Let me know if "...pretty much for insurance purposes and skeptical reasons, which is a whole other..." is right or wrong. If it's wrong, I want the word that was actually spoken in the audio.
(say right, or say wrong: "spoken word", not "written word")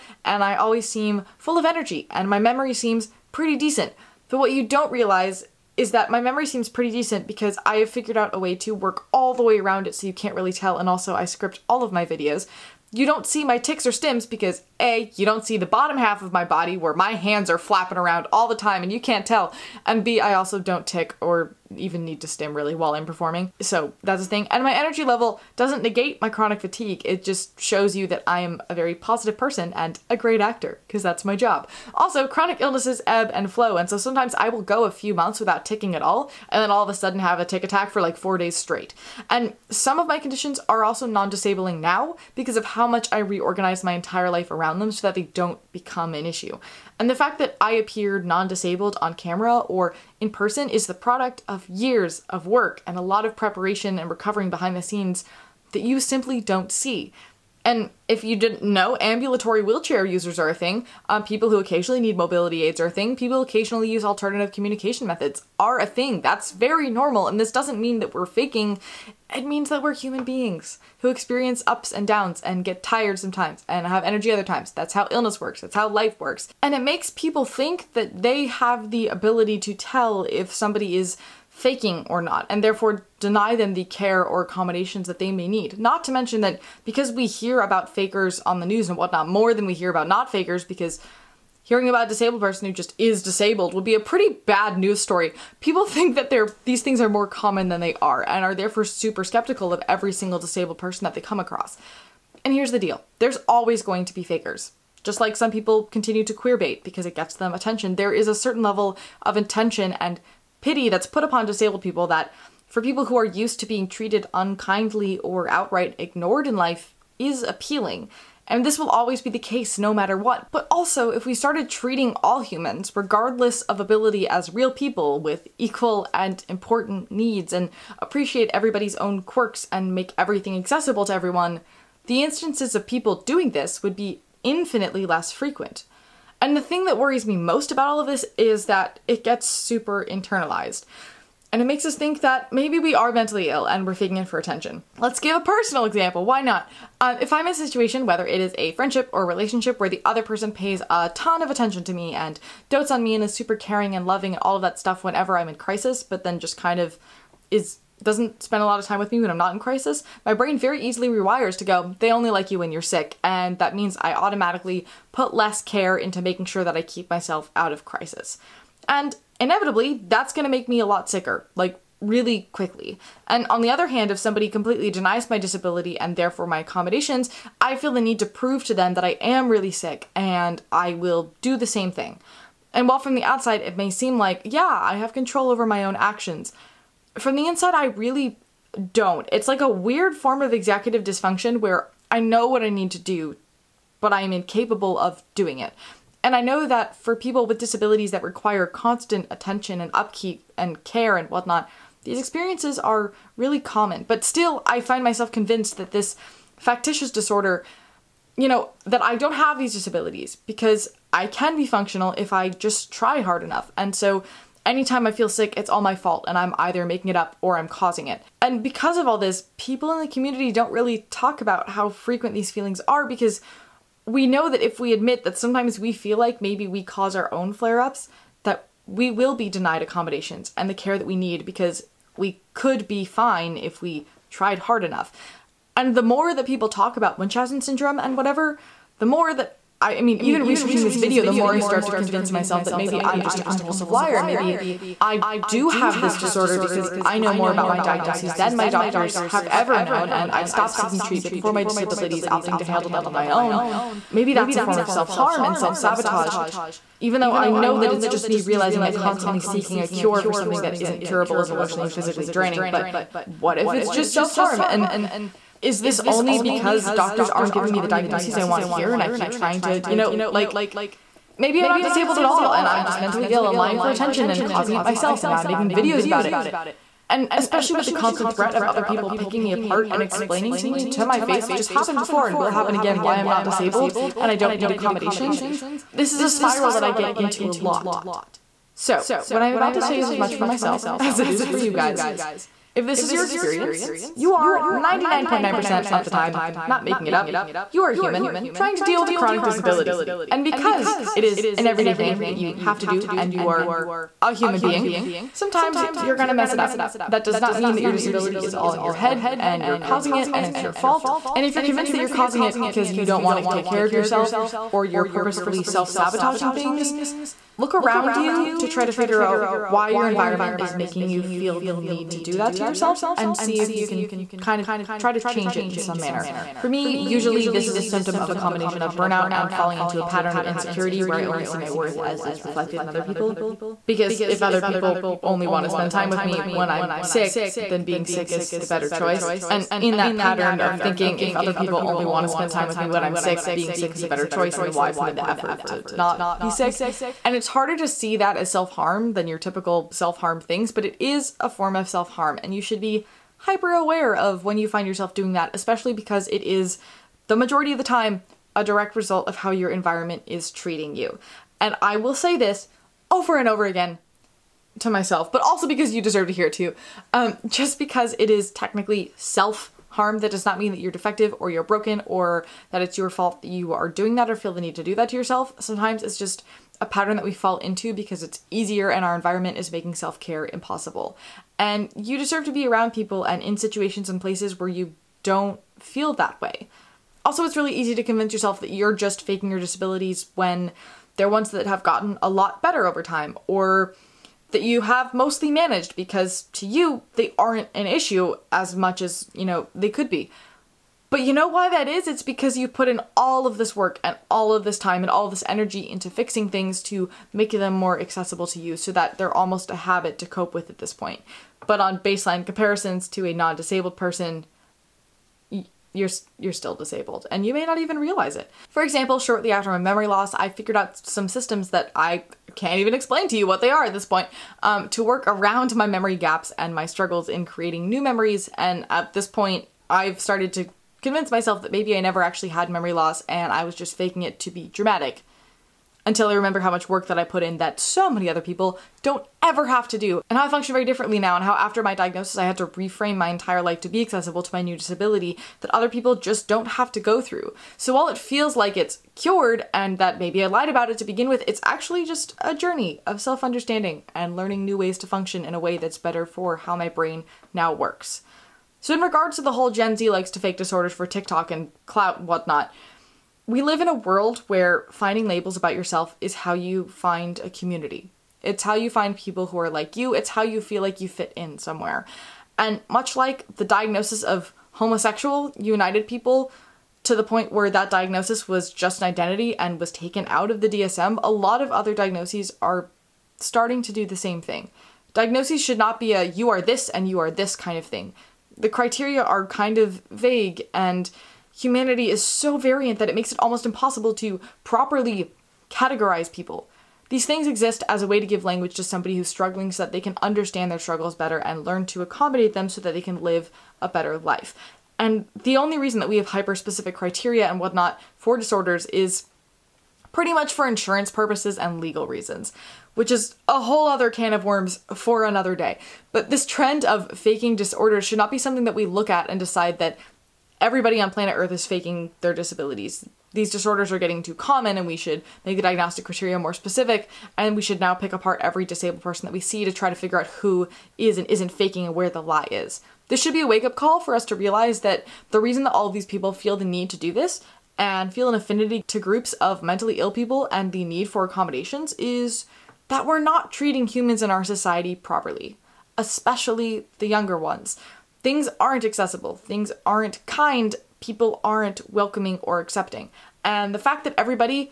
wrong: "legal", not "skeptical".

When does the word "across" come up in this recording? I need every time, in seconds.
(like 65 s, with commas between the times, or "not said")
101 s.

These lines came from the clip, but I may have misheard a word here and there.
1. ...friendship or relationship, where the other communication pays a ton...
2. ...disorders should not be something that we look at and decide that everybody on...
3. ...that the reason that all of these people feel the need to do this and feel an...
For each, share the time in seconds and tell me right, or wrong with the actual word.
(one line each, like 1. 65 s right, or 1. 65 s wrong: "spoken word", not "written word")
1. 148 s wrong: "person", not "communication"
2. 517 s right
3. 534 s right.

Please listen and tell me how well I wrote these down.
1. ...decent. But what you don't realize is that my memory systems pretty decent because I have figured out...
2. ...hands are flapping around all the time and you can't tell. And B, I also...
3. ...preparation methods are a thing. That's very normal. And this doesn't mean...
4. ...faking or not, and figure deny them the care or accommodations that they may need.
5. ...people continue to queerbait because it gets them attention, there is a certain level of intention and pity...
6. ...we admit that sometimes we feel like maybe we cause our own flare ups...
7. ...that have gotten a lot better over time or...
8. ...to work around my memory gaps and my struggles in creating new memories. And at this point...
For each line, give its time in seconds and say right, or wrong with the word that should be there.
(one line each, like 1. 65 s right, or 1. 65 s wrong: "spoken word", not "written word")
1. 3 s wrong: "seems", not "systems"
2. 17 s right
3. 64 s wrong: "communication", not "preparation"
4. 81 s wrong: "therefore", not "figure"
5. 105 s right
6. 224 s right
7. 391 s right
8. 424 s right.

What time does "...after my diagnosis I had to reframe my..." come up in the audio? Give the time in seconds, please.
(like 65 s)
441 s.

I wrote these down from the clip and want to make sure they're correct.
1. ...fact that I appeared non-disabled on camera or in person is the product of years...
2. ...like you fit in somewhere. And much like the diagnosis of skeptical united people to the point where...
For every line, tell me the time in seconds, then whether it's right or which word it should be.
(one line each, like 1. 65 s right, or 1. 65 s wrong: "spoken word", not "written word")
1. 47 s right
2. 470 s wrong: "homosexual", not "skeptical".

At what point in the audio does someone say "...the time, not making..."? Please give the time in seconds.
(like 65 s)
296 s.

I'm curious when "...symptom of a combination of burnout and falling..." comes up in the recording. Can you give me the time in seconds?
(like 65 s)
327 s.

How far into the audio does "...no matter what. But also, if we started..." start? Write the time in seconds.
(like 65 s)
119 s.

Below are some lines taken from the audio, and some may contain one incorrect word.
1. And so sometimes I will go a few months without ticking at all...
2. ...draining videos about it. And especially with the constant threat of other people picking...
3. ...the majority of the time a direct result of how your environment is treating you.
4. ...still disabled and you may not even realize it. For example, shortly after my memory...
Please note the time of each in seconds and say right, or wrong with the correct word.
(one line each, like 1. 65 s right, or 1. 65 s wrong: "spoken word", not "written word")
1. 33 s right
2. 275 s wrong: "making", not "draining"
3. 357 s right
4. 416 s right.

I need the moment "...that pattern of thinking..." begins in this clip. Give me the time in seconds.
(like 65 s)
339 s.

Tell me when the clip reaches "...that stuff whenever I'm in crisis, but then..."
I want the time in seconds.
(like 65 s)
154 s.